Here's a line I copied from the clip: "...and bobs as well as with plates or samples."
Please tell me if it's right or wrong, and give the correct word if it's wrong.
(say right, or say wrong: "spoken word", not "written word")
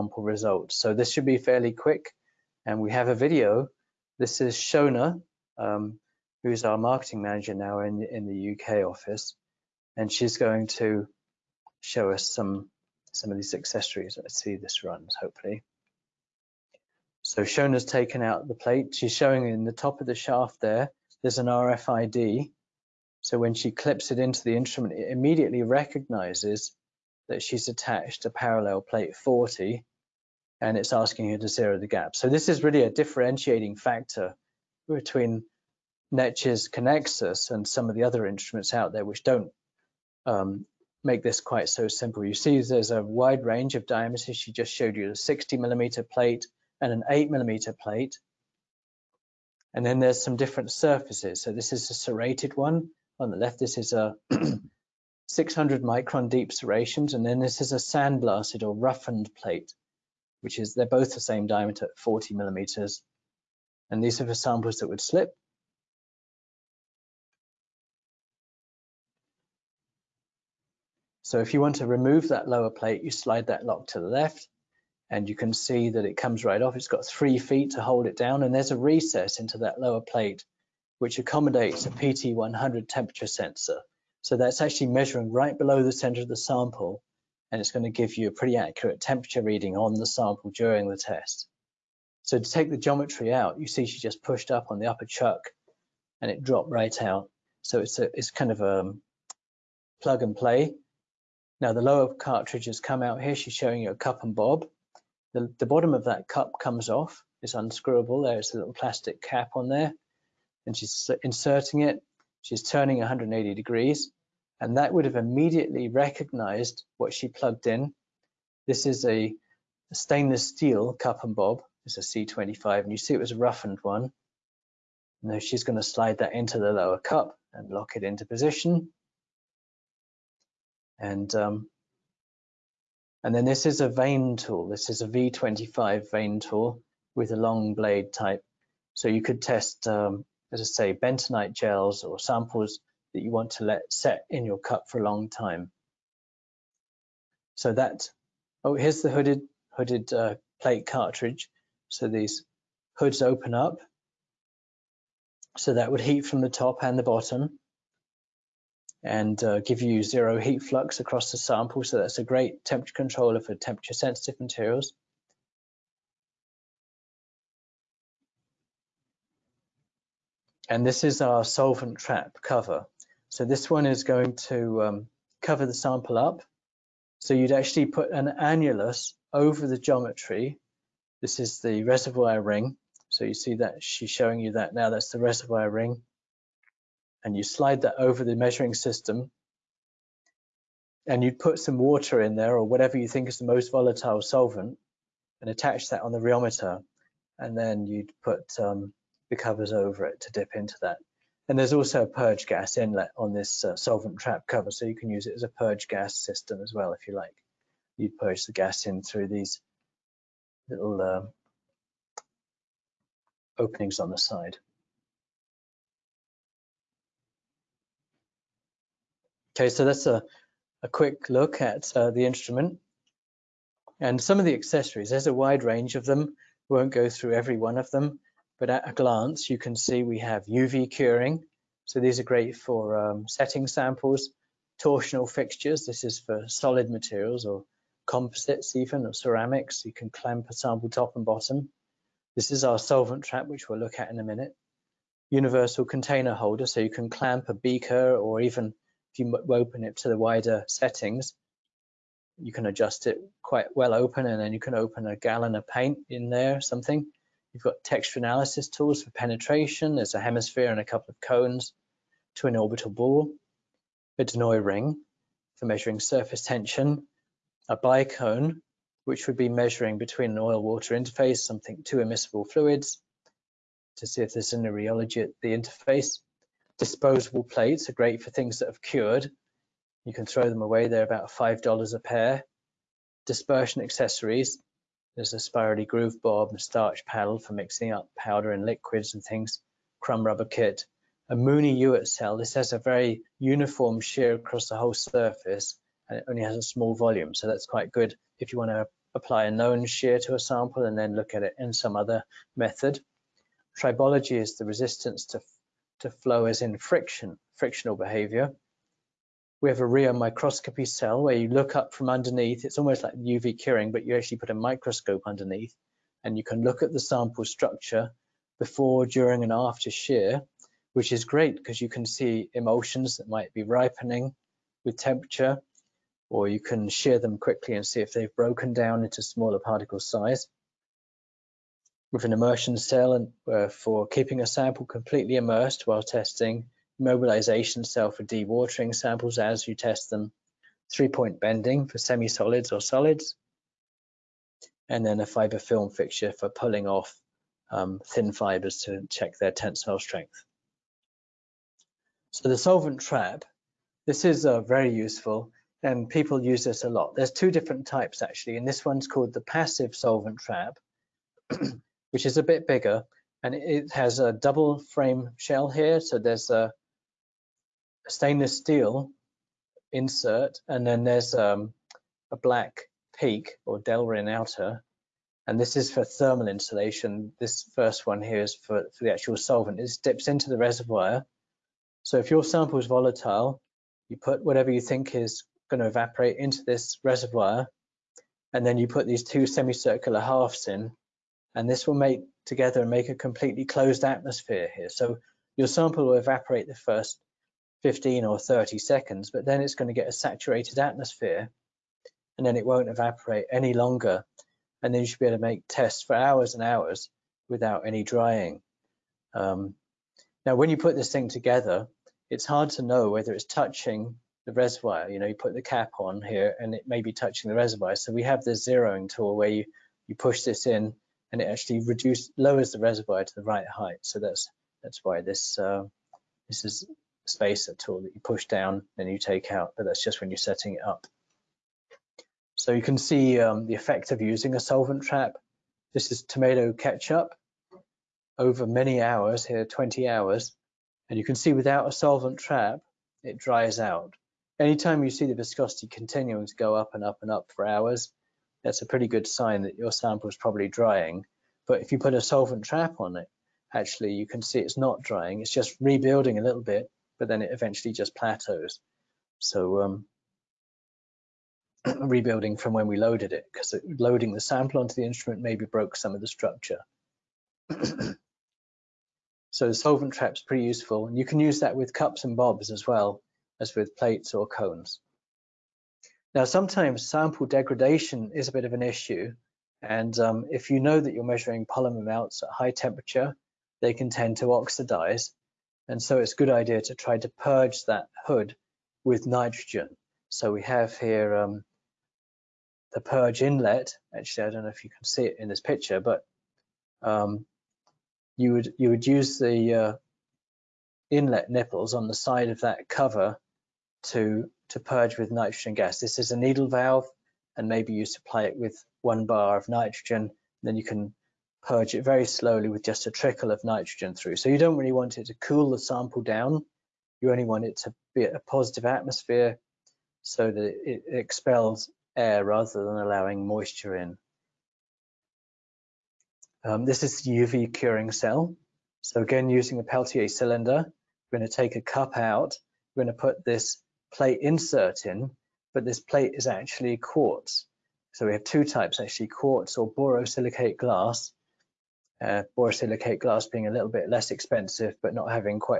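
wrong: "cones", not "samples".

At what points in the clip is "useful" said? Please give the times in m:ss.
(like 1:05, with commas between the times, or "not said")
5:54, 7:50.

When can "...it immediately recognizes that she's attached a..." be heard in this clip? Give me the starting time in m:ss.
0:24.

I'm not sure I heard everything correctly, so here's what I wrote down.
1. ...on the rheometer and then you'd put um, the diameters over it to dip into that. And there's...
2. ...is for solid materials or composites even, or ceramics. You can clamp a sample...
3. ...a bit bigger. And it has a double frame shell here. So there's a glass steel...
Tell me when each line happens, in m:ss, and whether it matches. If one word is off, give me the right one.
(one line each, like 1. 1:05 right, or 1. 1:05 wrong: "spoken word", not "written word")
1. 3:16 wrong: "covers", not "diameters"
2. 3:56 right
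3. 6:02 wrong: "stainless", not "glass".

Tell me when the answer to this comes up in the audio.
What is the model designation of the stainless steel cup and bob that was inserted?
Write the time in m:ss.
2:01.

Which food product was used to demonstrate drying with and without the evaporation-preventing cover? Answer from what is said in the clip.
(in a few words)
Tomato ketchup.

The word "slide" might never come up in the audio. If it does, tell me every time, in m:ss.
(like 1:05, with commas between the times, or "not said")
1:13, 2:05, 3:07.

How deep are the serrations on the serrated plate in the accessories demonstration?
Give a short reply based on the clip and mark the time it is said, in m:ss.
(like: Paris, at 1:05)
600 microns, at 0:55.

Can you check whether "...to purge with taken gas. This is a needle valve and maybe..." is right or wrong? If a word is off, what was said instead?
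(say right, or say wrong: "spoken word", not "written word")
wrong: "nitrogen", not "taken".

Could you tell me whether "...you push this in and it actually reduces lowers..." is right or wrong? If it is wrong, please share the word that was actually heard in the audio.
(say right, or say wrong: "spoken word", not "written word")
right.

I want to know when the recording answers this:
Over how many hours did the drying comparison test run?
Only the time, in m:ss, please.
7:19.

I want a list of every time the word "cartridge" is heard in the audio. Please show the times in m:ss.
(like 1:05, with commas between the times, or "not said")
1:42, 2:30.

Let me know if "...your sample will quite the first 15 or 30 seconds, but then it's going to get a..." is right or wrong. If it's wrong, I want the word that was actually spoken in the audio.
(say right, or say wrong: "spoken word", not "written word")
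wrong: "evaporate", not "quite".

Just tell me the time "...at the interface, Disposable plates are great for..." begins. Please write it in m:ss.
4:35.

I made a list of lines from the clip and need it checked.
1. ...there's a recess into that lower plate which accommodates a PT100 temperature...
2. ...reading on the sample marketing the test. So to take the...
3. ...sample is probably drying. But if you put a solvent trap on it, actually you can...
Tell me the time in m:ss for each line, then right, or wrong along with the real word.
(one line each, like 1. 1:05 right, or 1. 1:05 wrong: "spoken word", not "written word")
1. 1:18 right
2. 1:29 wrong: "during", not "marketing"
3. 7:29 right.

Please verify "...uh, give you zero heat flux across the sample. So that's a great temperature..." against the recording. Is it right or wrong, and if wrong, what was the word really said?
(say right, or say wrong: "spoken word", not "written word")
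right.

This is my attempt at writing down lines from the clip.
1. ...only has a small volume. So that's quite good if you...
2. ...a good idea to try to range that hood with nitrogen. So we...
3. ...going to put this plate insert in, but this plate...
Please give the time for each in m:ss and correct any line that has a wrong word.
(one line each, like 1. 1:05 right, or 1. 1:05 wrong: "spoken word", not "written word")
1. 4:56 right
2. 8:06 wrong: "purge", not "range"
3. 8:53 right.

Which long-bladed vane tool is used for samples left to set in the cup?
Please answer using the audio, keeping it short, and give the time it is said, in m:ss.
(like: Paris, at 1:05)
V25, at 2:15.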